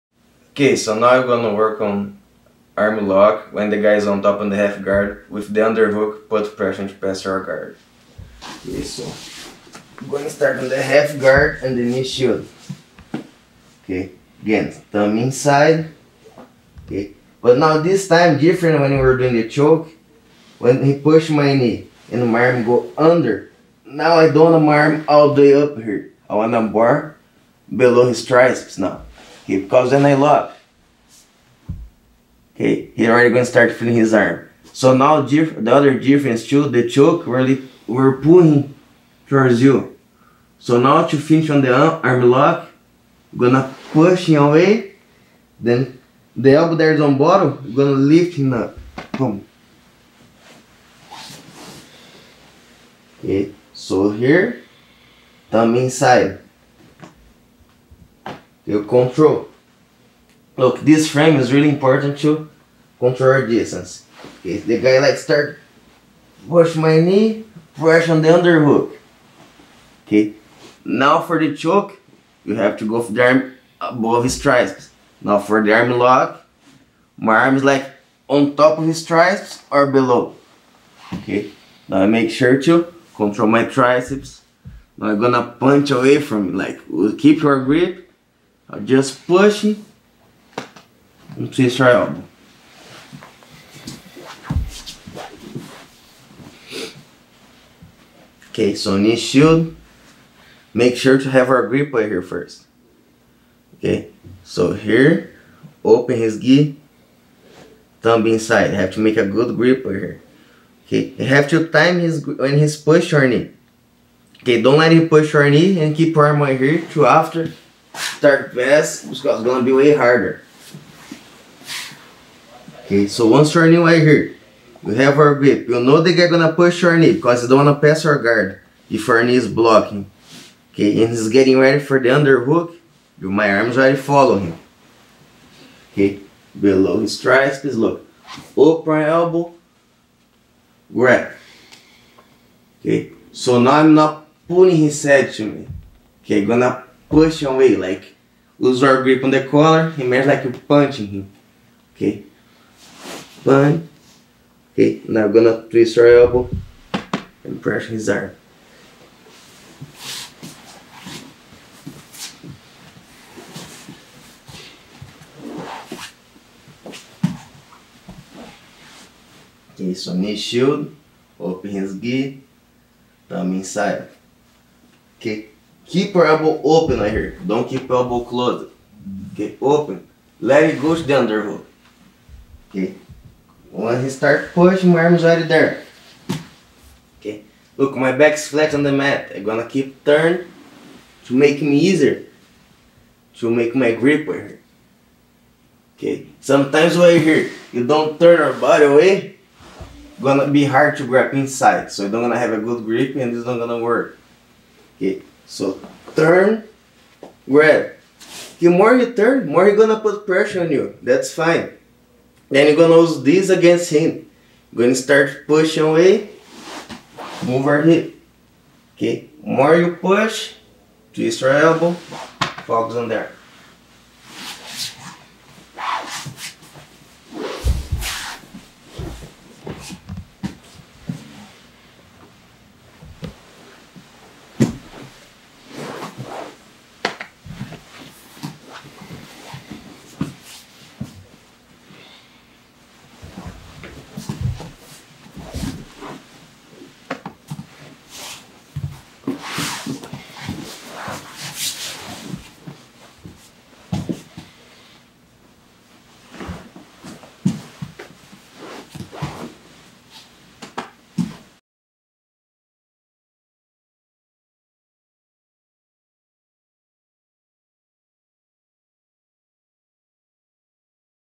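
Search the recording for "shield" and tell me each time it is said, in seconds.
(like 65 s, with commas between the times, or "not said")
12 s, 99 s, 170 s.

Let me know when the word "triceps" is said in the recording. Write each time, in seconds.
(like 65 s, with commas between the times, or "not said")
28 s, 74 s, 79 s, 83 s, 137 s.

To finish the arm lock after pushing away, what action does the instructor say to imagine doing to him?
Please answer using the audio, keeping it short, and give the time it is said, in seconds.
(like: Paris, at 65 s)
Punching him, at 150 s.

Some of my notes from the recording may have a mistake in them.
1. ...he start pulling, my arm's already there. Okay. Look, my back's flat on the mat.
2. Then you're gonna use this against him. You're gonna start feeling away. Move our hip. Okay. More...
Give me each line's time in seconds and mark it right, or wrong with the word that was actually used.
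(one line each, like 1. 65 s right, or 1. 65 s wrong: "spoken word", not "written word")
1. 184 s wrong: "pushing", not "pulling"
2. 212 s wrong: "pushing", not "feeling".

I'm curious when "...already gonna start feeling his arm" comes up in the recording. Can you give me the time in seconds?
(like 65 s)
33 s.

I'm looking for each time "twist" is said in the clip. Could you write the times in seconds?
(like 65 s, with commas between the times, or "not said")
91 s, 155 s, 221 s.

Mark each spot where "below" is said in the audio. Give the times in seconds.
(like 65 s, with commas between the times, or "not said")
27 s, 79 s, 136 s.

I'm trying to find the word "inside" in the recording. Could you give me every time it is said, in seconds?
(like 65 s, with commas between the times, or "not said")
15 s, 55 s, 108 s, 173 s, 201 s.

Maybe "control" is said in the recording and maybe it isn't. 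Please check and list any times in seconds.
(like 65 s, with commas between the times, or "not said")
58 s, 62 s, 83 s.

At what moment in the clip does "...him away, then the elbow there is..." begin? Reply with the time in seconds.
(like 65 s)
44 s.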